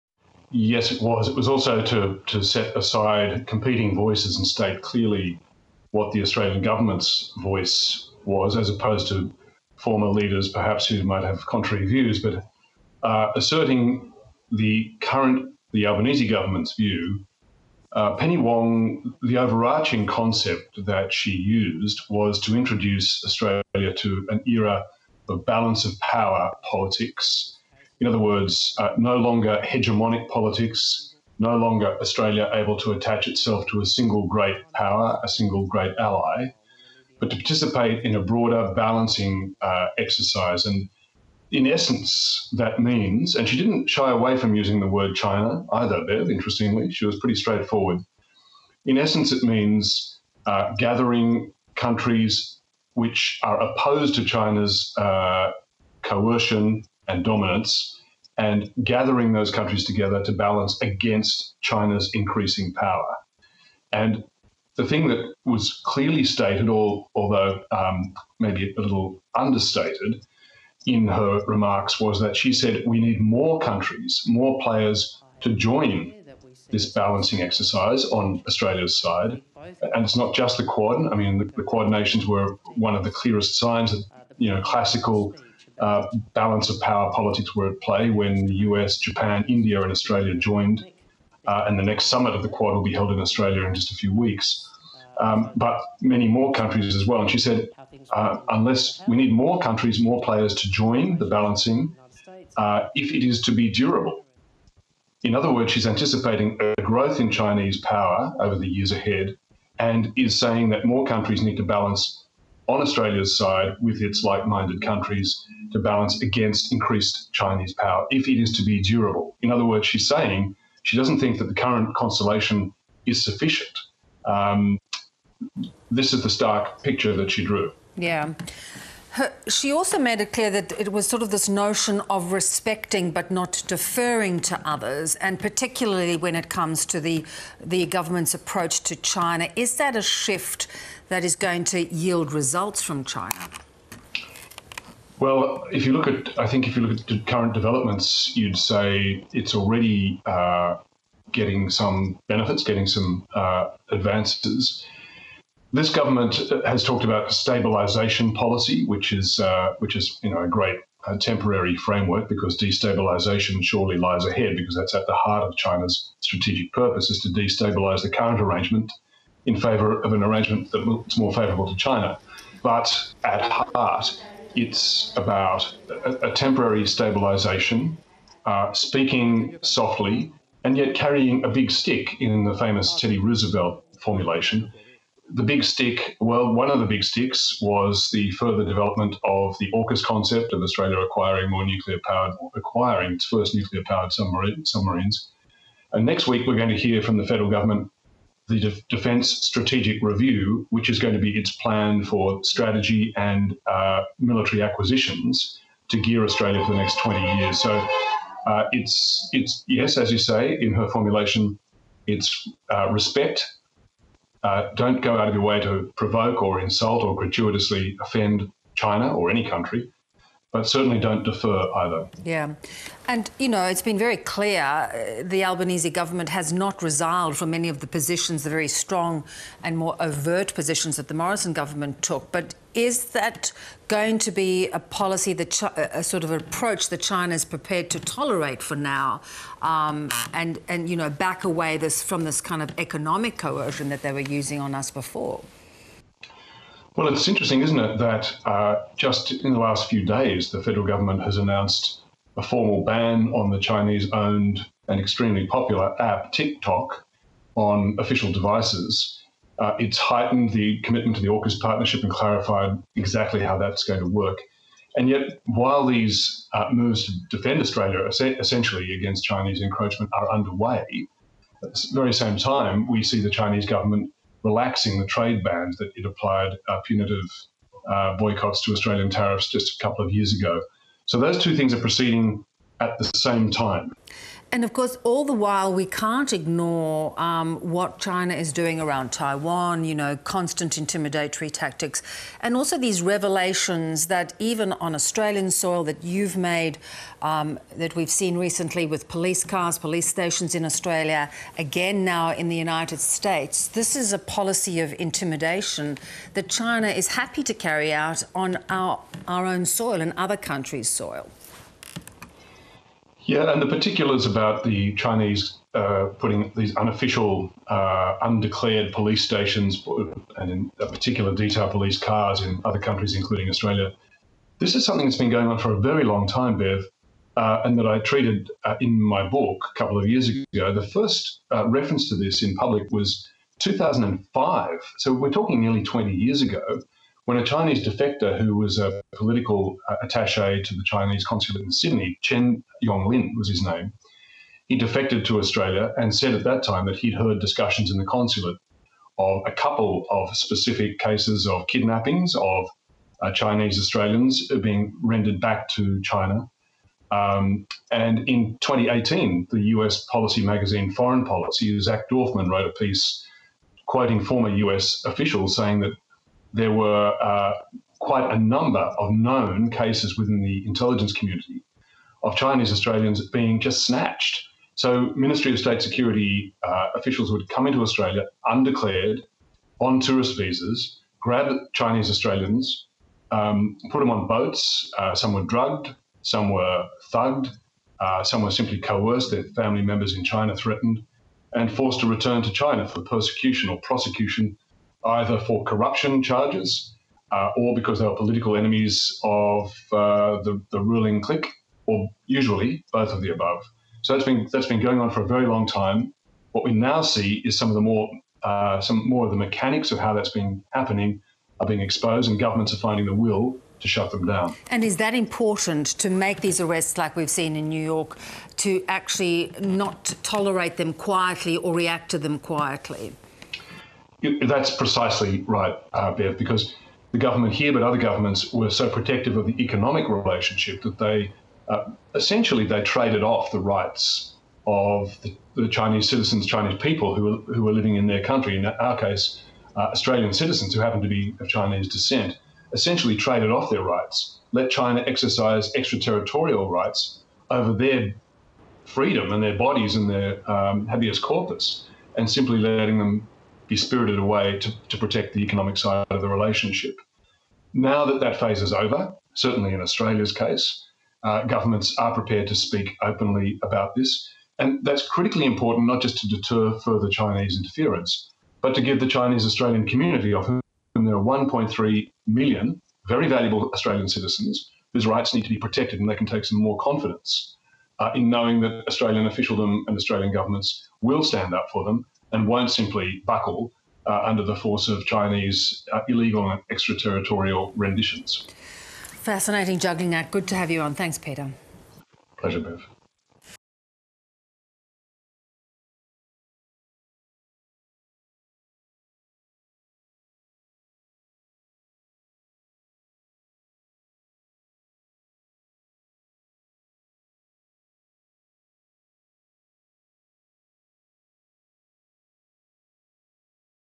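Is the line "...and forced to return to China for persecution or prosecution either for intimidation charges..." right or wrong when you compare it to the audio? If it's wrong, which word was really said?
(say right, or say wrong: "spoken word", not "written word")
wrong: "corruption", not "intimidation".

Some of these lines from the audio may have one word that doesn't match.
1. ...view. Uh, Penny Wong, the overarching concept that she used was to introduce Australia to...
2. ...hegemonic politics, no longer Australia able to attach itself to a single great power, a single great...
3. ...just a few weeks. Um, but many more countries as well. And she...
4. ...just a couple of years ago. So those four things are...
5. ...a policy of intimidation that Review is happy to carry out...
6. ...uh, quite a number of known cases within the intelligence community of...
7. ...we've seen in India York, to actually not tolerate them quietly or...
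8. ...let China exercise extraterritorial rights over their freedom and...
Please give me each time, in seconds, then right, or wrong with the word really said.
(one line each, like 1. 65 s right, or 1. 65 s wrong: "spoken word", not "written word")
1. 16 s right
2. 29 s right
3. 93 s right
4. 279 s wrong: "two", not "four"
5. 304 s wrong: "China", not "Review"
6. 367 s right
7. 417 s wrong: "New", not "India"
8. 444 s right.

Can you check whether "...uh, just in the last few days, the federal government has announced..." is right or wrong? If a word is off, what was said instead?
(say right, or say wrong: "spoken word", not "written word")
right.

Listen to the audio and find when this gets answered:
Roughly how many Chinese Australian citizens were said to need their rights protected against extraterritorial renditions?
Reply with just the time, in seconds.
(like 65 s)
471 s.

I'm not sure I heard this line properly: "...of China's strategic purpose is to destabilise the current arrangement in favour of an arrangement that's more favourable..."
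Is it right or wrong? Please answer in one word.
right.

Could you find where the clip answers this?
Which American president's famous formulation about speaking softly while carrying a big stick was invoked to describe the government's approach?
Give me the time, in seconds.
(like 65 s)
183 s.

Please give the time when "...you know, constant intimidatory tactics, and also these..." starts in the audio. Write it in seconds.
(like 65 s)
289 s.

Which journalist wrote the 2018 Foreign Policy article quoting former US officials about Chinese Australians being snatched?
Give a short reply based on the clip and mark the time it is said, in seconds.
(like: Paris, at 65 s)
Zach Dorfman, at 361 s.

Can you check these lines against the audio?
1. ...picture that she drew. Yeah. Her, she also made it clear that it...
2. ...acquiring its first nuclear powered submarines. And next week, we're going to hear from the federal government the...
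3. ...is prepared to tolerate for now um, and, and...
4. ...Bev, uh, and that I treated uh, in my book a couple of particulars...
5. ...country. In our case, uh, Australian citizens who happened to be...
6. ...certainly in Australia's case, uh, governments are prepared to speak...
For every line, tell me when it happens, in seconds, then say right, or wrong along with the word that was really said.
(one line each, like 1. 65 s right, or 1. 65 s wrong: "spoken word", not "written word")
1. 126 s right
2. 192 s right
3. 237 s right
4. 326 s wrong: "years", not "particulars"
5. 438 s right
6. 459 s right.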